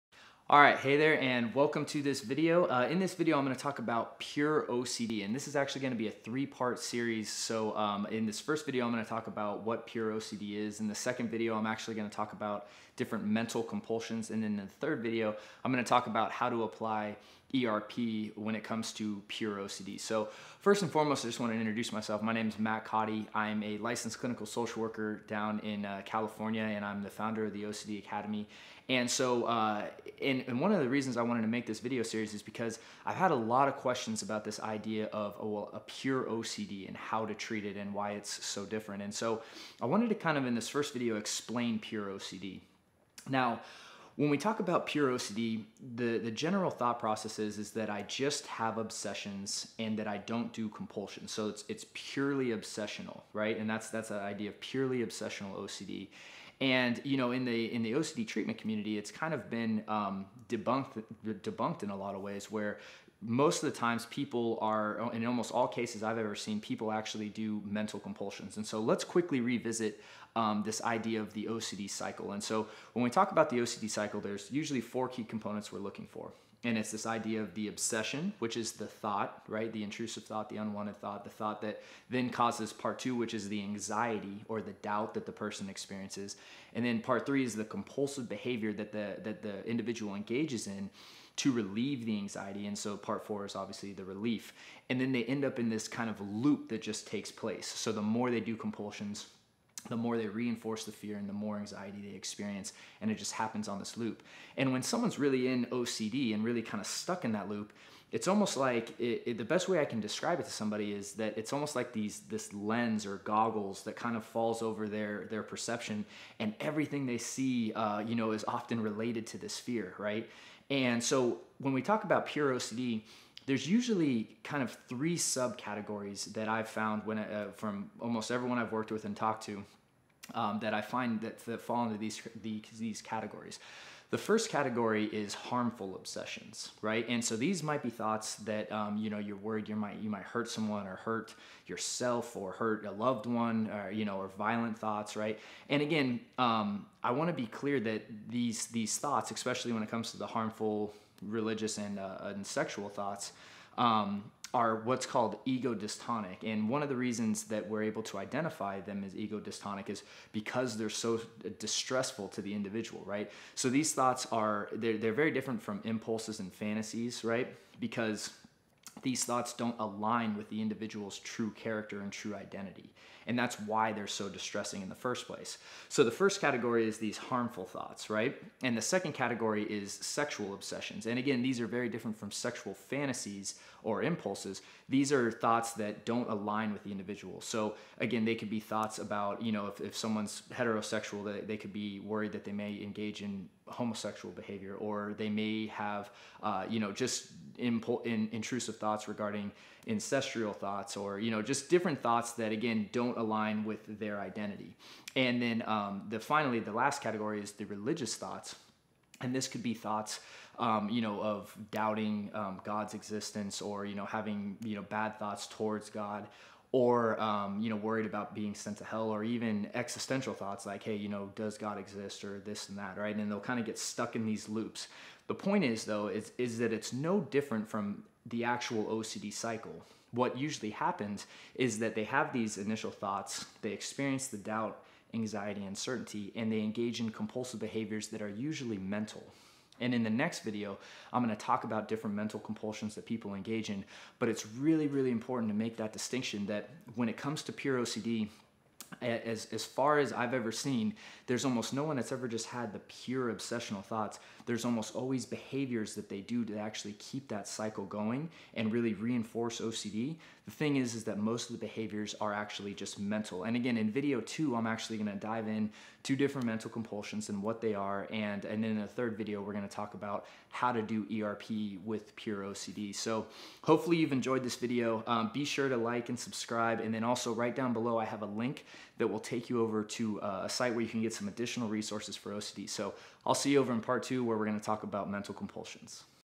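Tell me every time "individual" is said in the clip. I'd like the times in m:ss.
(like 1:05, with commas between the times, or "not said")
1:29, 2:42, 2:50, 3:06.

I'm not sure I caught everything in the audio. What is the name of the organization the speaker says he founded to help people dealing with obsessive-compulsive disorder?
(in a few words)
OCD Academy.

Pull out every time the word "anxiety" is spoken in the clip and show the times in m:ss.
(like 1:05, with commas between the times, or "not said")
1:23, 1:32, 1:41, 3:55.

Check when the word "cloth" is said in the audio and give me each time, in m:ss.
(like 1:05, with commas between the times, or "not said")
not said.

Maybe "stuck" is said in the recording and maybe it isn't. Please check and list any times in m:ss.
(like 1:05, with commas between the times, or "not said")
1:46, 3:43.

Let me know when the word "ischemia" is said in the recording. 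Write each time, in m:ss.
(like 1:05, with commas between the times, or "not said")
not said.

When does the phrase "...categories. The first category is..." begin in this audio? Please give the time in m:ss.
2:13.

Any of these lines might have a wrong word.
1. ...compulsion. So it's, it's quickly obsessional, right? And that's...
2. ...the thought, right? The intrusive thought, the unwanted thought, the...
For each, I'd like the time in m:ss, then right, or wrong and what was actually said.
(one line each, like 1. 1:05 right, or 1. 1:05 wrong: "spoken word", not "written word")
1. 0:50 wrong: "purely", not "quickly"
2. 1:18 right.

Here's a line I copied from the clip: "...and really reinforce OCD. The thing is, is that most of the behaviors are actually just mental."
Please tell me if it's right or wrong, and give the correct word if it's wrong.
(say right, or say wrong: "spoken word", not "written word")
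right.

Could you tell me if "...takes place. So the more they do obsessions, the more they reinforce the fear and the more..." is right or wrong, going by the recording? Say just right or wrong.
wrong.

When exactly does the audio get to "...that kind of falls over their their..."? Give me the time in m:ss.
1:53.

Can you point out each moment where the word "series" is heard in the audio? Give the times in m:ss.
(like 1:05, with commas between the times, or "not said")
0:06, 0:32.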